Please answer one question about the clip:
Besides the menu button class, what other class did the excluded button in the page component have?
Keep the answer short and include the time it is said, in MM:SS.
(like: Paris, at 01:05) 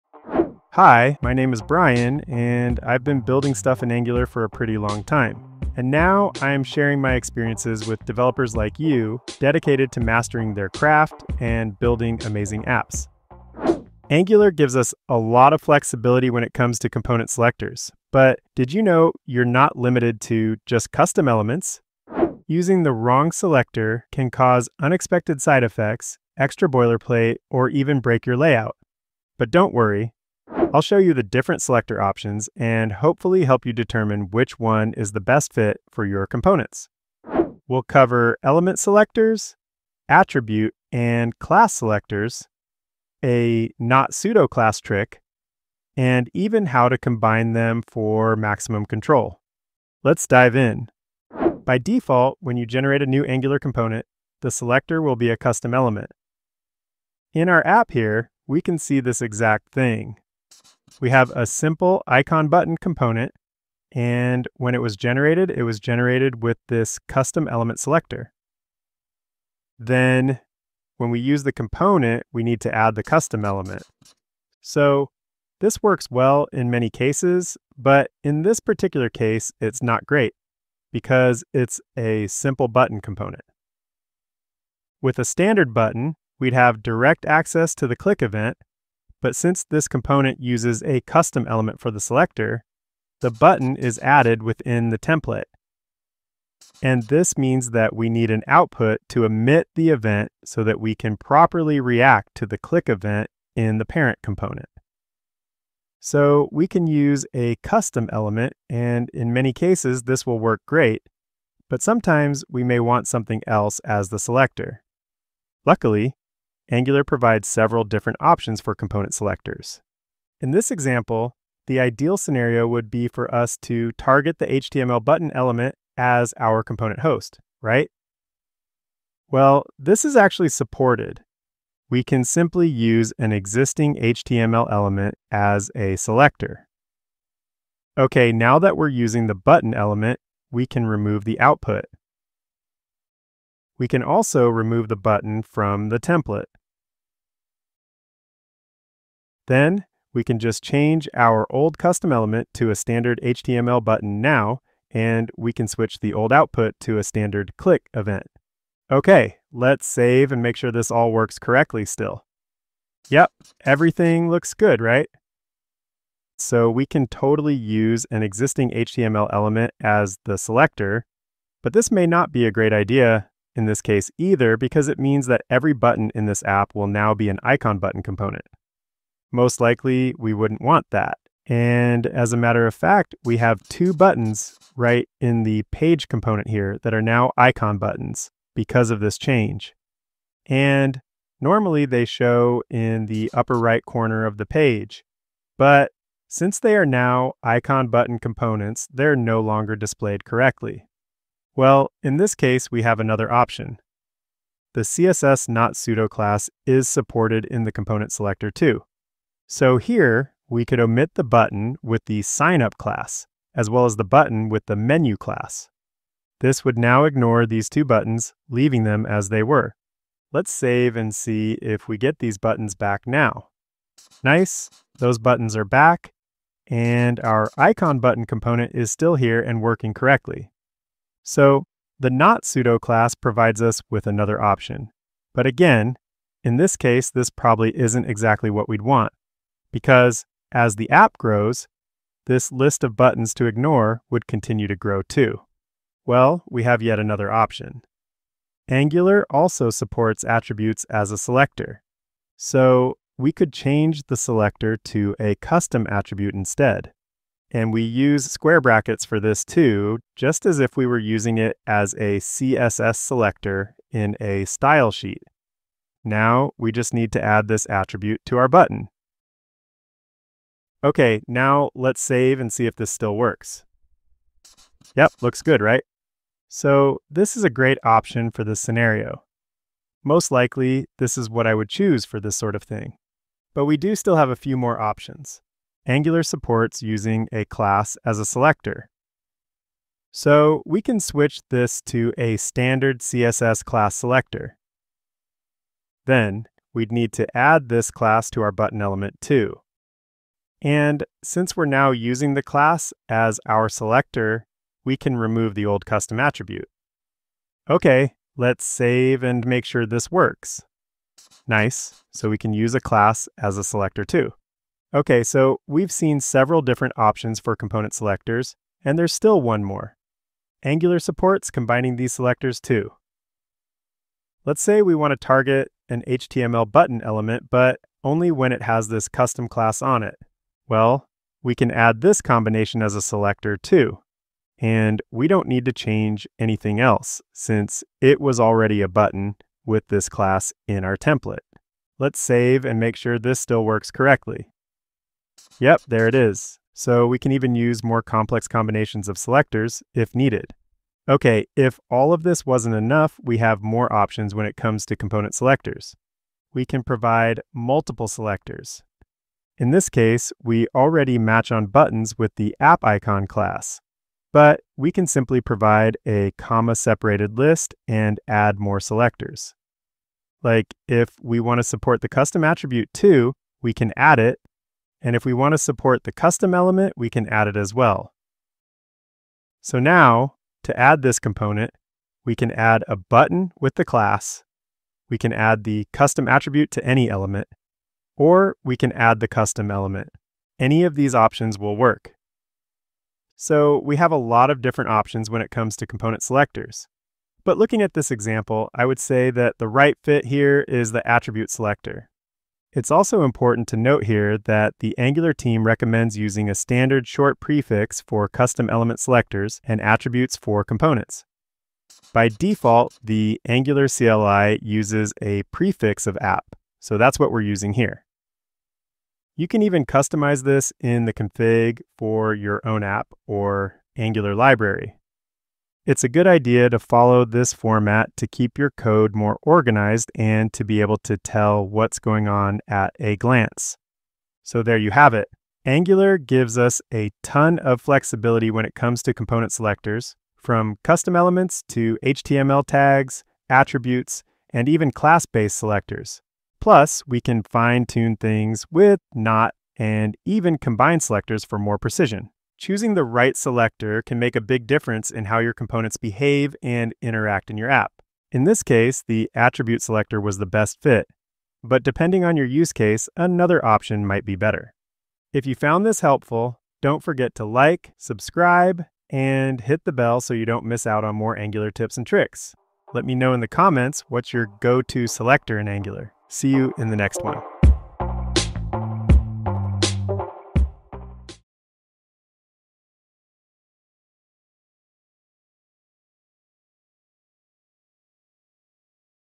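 signup, at 03:32.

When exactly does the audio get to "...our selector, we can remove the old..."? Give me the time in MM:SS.
05:03.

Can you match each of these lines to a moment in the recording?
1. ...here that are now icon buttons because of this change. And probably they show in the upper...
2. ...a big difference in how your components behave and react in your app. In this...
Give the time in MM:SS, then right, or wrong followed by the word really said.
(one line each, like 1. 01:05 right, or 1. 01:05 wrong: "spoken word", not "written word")
1. 03:06 wrong: "normally", not "probably"
2. 07:34 wrong: "interact", not "react".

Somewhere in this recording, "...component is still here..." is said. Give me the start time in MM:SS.
03:48.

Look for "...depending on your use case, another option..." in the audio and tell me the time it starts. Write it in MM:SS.
07:41.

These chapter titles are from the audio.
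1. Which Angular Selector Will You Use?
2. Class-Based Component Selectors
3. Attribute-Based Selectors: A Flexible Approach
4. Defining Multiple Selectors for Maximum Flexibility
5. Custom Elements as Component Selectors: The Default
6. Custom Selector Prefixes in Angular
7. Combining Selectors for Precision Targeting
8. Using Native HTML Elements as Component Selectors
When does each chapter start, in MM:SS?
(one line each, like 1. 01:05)
1. 07:14
2. 04:45
3. 04:05
4. 05:50
5. 00:51
6. 06:42
7. 05:20
8. 02:00.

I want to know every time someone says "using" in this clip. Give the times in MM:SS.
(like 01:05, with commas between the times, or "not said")
00:22, 02:18, 04:20, 04:46, 05:01, 06:46, 06:57.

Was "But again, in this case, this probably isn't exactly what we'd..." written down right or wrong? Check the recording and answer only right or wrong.
right.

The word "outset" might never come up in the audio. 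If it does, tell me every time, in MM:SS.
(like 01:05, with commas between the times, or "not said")
not said.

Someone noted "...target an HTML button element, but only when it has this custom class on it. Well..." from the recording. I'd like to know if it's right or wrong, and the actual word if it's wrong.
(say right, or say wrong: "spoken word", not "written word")
right.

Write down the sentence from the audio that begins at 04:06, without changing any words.
Well, we have yet another option.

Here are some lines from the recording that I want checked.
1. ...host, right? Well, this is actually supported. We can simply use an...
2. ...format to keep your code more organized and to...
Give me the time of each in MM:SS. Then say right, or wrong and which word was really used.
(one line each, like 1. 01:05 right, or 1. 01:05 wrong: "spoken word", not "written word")
1. 02:07 right
2. 07:07 right.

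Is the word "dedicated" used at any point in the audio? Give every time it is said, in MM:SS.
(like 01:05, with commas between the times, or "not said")
00:09.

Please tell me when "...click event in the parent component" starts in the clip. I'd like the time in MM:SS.
01:42.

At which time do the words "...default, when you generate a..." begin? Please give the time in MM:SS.
00:51.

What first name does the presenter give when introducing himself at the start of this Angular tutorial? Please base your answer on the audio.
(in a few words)
Brian.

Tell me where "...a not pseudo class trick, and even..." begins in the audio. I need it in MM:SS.
00:43.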